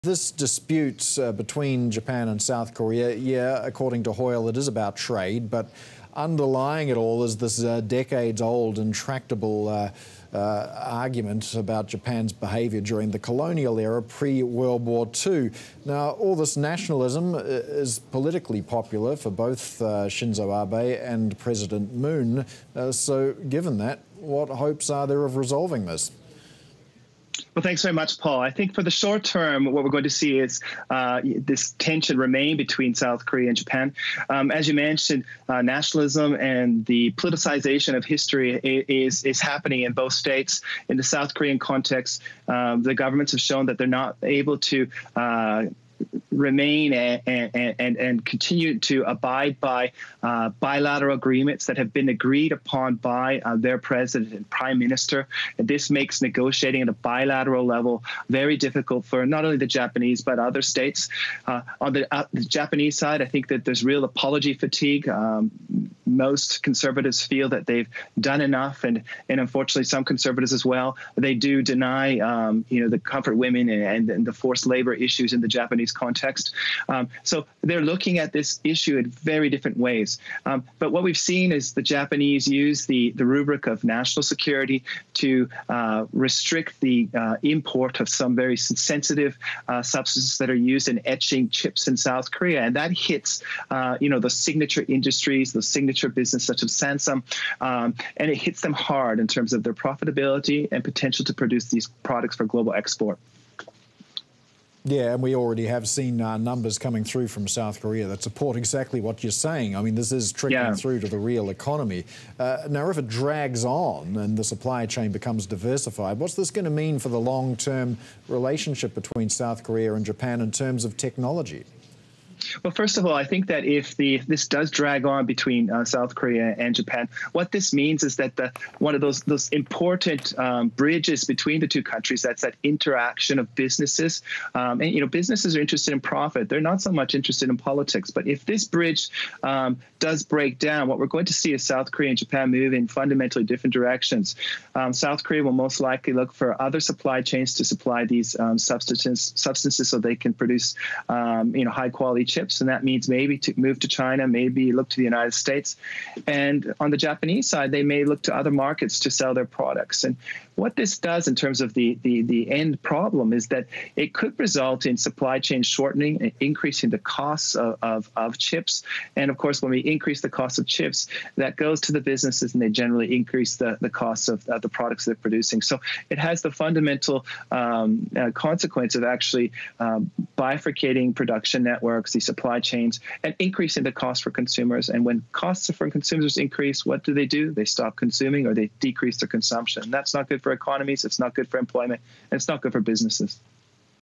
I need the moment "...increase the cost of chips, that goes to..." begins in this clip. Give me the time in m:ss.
2:49.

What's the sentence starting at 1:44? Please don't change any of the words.
Yeah, and we already have seen uh, numbers coming through from South Korea that support exactly what you're saying.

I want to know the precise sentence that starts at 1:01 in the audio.
Uh, on the, uh, the, Japanese side, I think that there's real apology fatigue.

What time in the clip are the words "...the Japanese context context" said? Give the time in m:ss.
1:15.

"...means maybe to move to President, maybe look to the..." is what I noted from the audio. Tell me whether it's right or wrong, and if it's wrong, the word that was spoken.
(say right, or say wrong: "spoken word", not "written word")
wrong: "China", not "President".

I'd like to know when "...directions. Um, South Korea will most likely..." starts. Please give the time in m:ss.
2:23.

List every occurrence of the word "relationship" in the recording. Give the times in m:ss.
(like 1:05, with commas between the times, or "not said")
1:58, 2:32.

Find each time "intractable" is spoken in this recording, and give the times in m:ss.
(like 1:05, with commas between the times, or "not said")
0:08.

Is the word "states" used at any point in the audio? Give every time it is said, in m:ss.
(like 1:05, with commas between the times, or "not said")
0:40, 1:00, 2:35.